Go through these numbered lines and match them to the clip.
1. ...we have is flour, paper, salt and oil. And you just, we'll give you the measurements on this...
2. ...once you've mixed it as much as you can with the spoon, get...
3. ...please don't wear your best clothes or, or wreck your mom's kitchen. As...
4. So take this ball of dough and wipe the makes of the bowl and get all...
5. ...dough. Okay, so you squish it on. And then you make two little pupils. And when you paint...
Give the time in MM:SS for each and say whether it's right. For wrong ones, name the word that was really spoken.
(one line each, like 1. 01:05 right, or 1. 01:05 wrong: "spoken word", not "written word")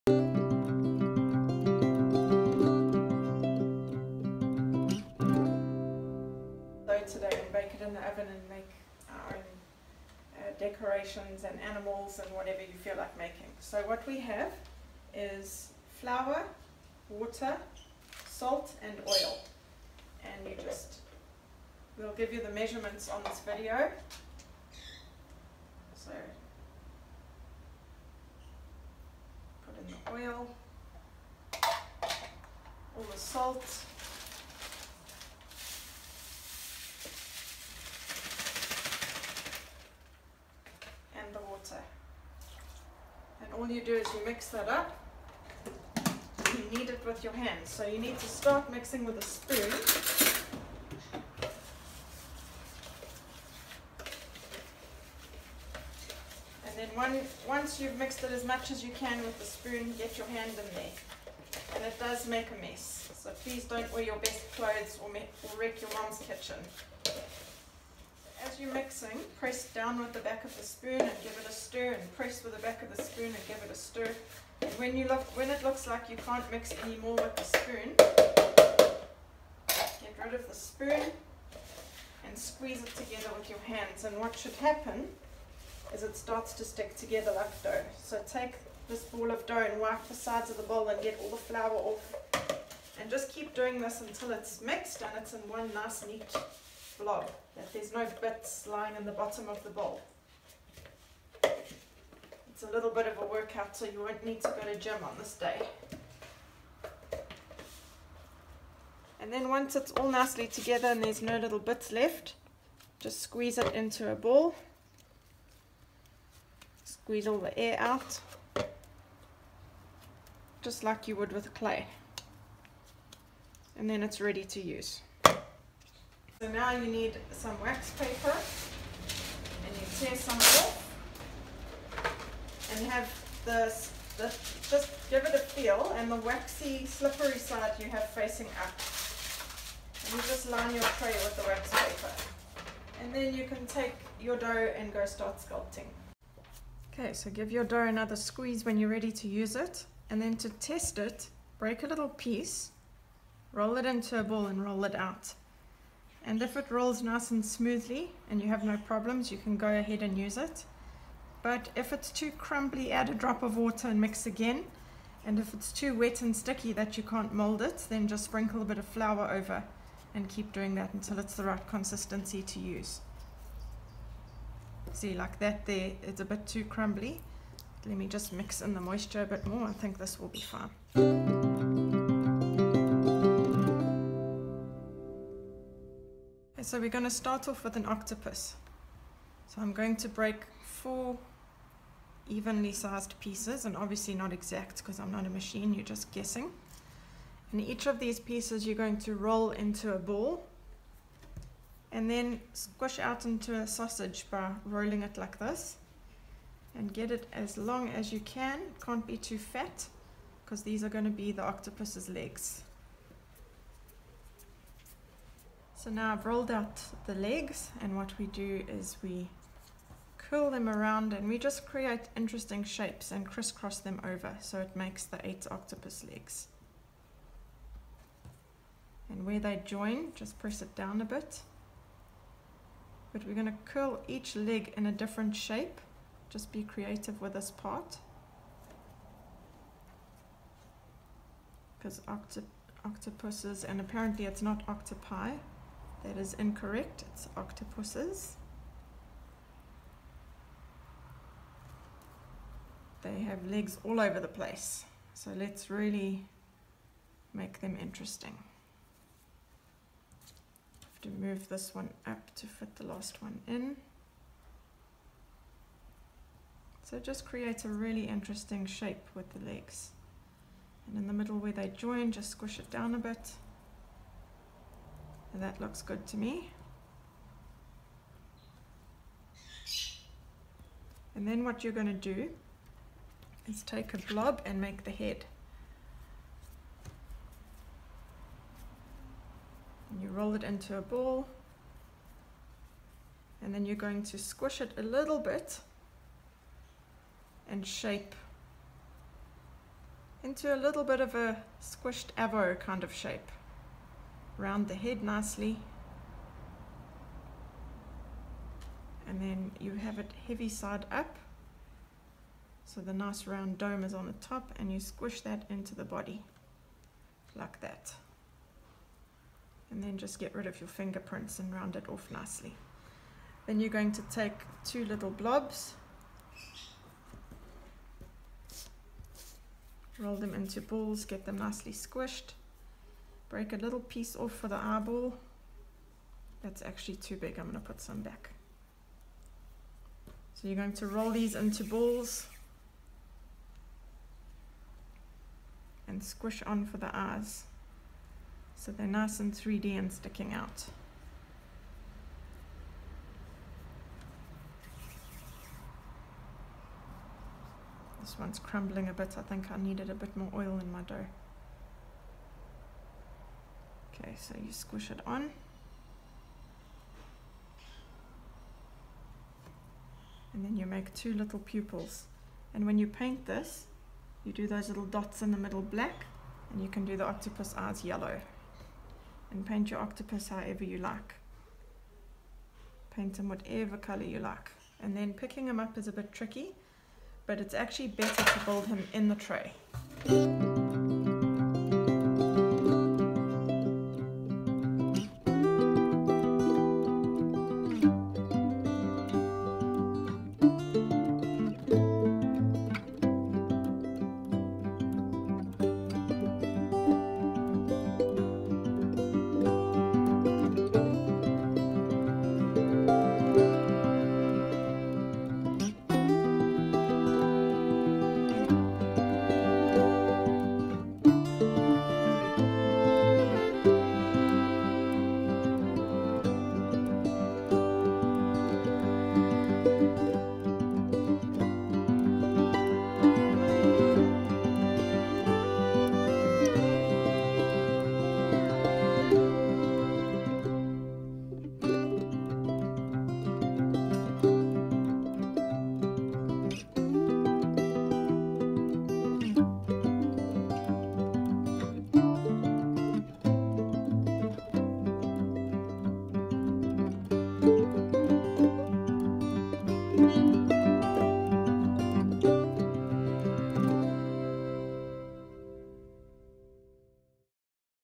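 1. 00:14 wrong: "water", not "paper"
2. 00:57 right
3. 01:03 right
4. 01:28 wrong: "sides", not "makes"
5. 06:00 right.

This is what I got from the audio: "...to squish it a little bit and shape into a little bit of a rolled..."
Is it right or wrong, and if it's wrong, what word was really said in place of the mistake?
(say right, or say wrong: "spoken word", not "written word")
wrong: "squished", not "rolled".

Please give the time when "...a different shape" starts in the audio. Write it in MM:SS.
03:54.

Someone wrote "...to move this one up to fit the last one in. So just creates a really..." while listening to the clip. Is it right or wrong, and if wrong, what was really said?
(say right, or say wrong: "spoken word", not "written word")
right.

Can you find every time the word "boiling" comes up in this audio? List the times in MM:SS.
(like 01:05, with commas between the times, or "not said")
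not said.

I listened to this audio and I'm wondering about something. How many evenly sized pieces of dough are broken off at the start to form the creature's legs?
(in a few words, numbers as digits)
4.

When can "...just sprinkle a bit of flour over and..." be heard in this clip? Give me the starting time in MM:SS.
02:48.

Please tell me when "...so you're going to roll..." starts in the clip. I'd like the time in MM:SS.
05:40.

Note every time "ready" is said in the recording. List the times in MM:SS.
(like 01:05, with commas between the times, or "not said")
02:04, 02:28.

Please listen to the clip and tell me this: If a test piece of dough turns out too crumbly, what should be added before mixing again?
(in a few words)
a drop of water.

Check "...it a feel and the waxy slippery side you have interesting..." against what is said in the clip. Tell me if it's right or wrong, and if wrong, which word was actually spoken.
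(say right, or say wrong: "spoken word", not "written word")
wrong: "facing", not "interesting".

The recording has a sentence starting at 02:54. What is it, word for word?
See, like that there, it's a bit too crumbly.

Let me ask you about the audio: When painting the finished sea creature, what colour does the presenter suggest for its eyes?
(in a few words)
yellow.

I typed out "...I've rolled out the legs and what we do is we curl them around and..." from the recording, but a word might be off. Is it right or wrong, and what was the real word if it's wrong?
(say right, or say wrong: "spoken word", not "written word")
right.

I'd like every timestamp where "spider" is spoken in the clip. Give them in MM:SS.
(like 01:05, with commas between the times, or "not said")
not said.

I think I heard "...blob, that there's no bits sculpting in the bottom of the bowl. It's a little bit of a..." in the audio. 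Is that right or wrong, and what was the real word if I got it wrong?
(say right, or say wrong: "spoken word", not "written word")
wrong: "lying", not "sculpting".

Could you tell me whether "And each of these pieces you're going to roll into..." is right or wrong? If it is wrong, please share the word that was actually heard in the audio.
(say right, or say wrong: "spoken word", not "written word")
right.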